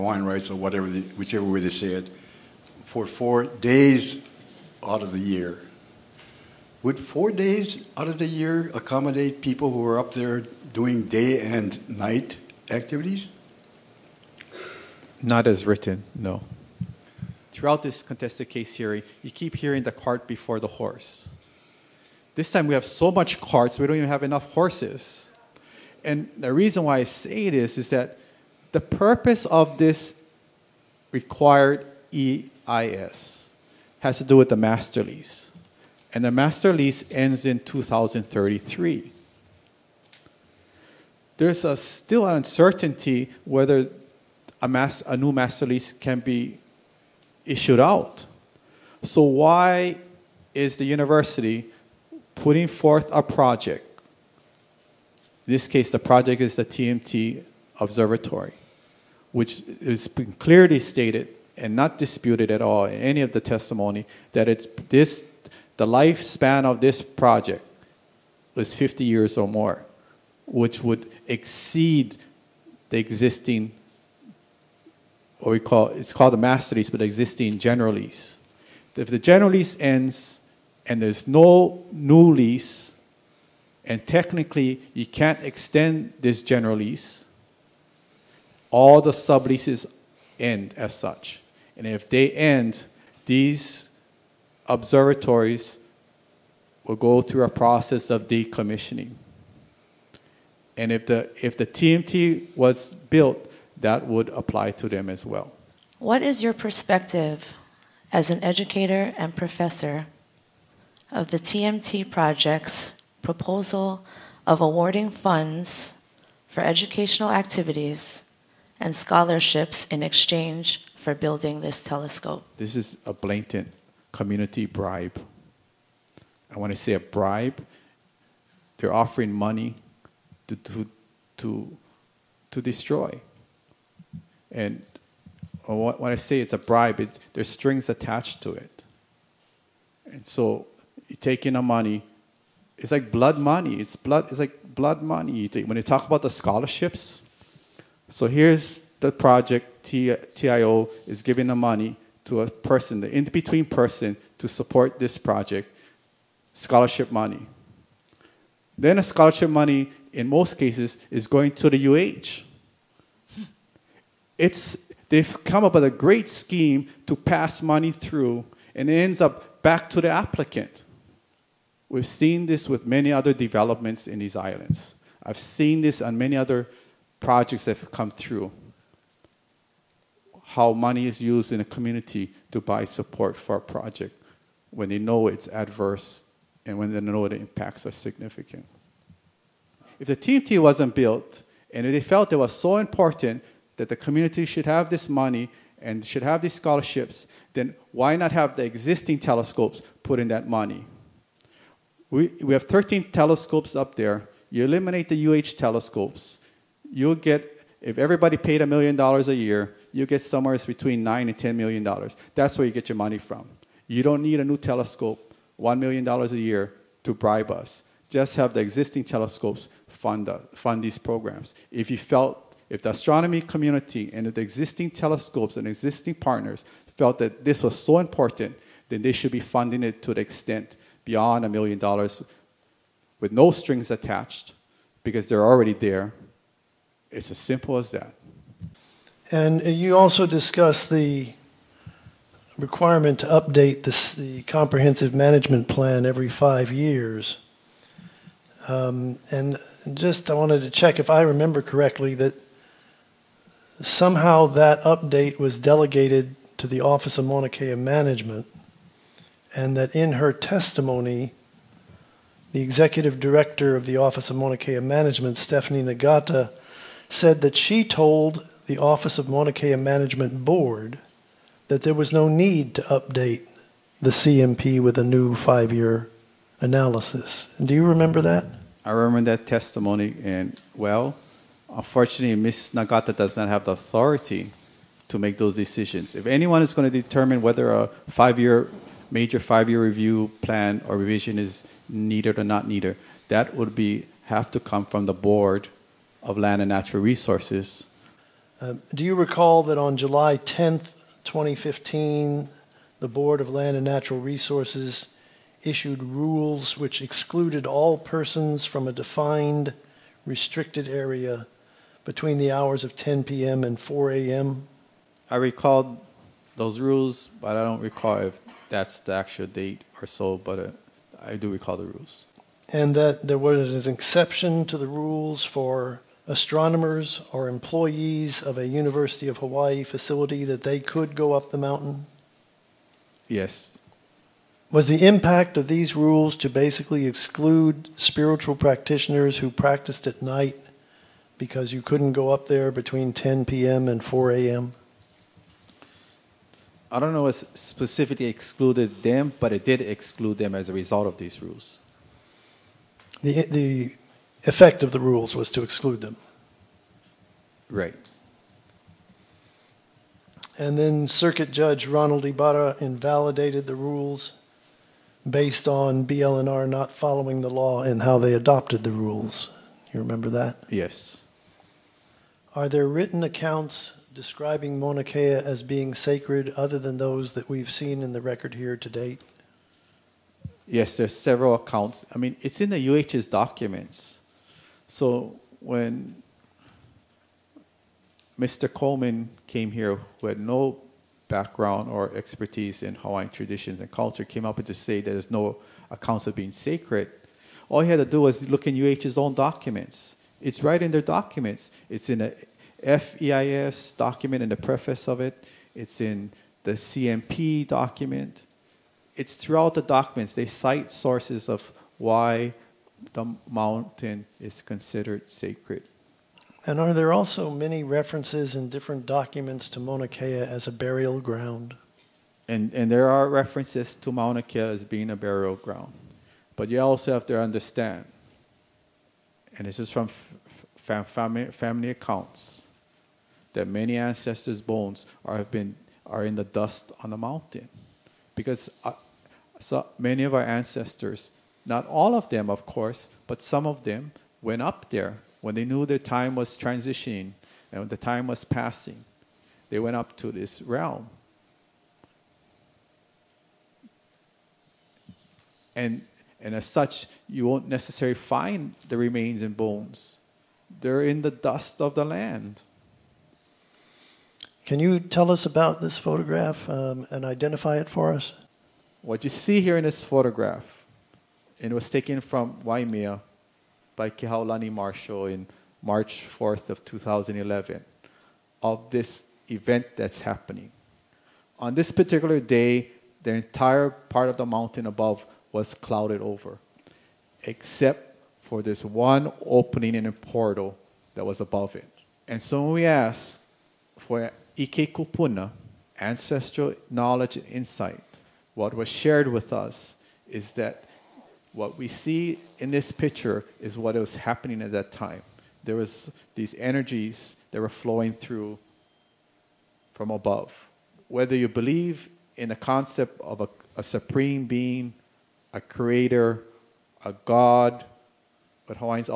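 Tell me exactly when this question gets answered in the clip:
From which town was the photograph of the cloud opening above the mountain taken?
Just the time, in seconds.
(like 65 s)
472 s.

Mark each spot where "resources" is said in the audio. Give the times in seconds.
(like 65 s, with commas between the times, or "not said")
297 s, 304 s.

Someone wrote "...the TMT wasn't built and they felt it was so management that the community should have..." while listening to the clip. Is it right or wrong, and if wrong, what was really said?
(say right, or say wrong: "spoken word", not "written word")
wrong: "important", not "management".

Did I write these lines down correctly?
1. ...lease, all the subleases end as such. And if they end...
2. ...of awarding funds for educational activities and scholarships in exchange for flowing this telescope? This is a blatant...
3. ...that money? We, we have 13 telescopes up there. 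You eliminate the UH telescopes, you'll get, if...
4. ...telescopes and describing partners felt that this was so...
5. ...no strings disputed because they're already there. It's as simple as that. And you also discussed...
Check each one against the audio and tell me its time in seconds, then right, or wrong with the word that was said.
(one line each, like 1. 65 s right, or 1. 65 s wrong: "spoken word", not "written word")
1. 86 s right
2. 114 s wrong: "building", not "flowing"
3. 200 s right
4. 224 s wrong: "existing", not "describing"
5. 233 s wrong: "attached", not "disputed".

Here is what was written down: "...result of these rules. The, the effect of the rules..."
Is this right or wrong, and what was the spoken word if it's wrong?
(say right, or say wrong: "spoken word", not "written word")
right.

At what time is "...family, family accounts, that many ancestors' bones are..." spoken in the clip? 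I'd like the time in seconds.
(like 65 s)
430 s.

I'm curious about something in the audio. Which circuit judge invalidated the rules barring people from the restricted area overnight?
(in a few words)
Ronald Ibarra.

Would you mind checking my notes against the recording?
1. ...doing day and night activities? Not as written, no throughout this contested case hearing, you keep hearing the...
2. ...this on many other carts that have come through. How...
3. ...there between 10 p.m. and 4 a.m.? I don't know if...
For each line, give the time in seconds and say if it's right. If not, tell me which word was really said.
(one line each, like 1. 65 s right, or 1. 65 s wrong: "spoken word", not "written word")
1. 10 s right
2. 175 s wrong: "projects", not "carts"
3. 342 s right.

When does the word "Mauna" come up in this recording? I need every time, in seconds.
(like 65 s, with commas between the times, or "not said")
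257 s, 264 s, 269 s, 374 s, 419 s, 424 s.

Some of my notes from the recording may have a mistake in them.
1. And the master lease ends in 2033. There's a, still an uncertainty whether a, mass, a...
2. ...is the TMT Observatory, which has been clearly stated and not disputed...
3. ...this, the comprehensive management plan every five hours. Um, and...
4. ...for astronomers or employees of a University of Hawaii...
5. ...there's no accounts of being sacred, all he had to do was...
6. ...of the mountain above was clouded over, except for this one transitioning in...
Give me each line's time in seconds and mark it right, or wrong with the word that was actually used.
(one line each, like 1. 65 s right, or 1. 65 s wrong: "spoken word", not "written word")
1. 36 s right
2. 56 s right
3. 243 s wrong: "years", not "hours"
4. 325 s right
5. 395 s right
6. 484 s wrong: "opening", not "transitioning".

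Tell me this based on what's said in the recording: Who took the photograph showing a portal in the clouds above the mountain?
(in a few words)
Kehaulani Marshall.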